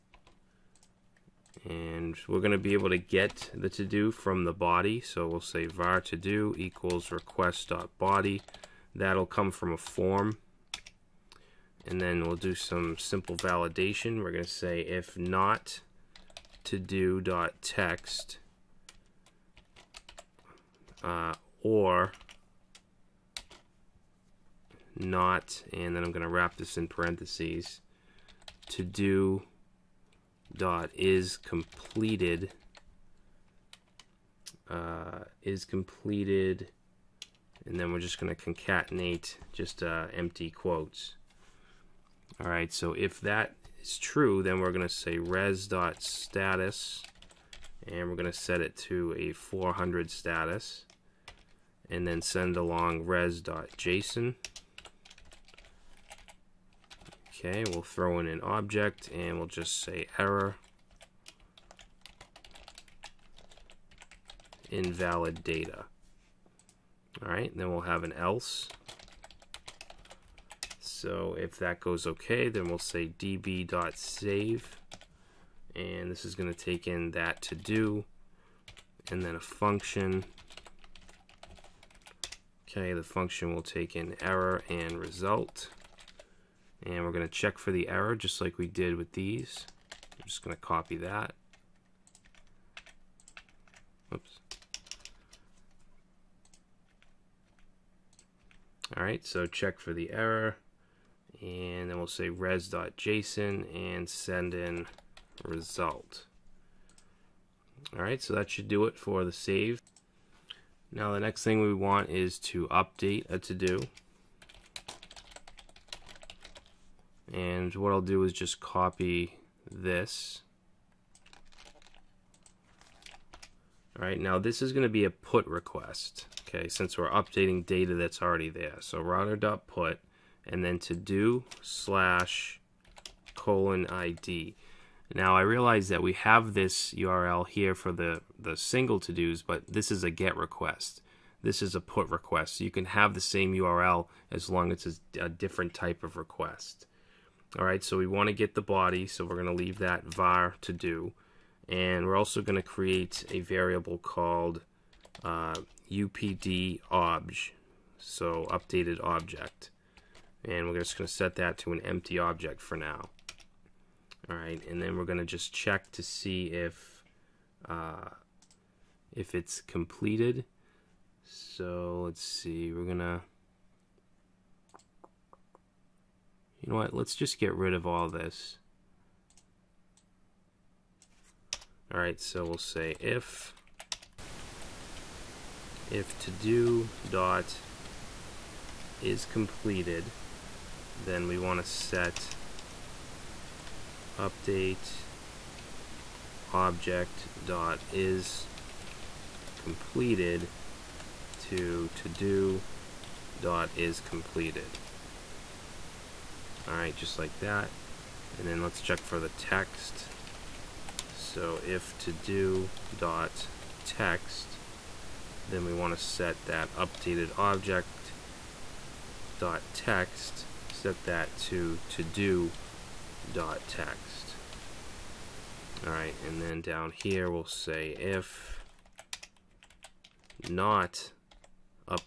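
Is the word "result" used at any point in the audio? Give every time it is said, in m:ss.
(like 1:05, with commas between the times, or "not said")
1:24, 1:45.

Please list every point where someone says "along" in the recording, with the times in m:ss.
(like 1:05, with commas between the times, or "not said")
0:52.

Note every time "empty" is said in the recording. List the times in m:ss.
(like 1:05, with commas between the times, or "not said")
0:40, 2:41.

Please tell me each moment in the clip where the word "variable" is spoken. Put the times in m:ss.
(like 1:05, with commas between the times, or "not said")
2:33.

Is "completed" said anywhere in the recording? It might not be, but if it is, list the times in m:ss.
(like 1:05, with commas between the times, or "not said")
0:31, 0:35, 2:49, 3:09, 3:19, 3:24.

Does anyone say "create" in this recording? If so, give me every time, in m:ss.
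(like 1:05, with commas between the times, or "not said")
2:32.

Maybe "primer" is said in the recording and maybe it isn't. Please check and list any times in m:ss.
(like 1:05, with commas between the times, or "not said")
not said.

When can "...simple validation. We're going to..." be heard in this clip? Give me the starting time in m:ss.
0:12.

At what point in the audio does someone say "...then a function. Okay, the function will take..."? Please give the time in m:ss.
1:19.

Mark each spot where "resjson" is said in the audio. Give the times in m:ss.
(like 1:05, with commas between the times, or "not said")
0:53, 1:42.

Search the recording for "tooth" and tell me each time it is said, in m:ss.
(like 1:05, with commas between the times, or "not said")
not said.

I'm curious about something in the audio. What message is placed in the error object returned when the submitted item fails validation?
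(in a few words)
invalid data.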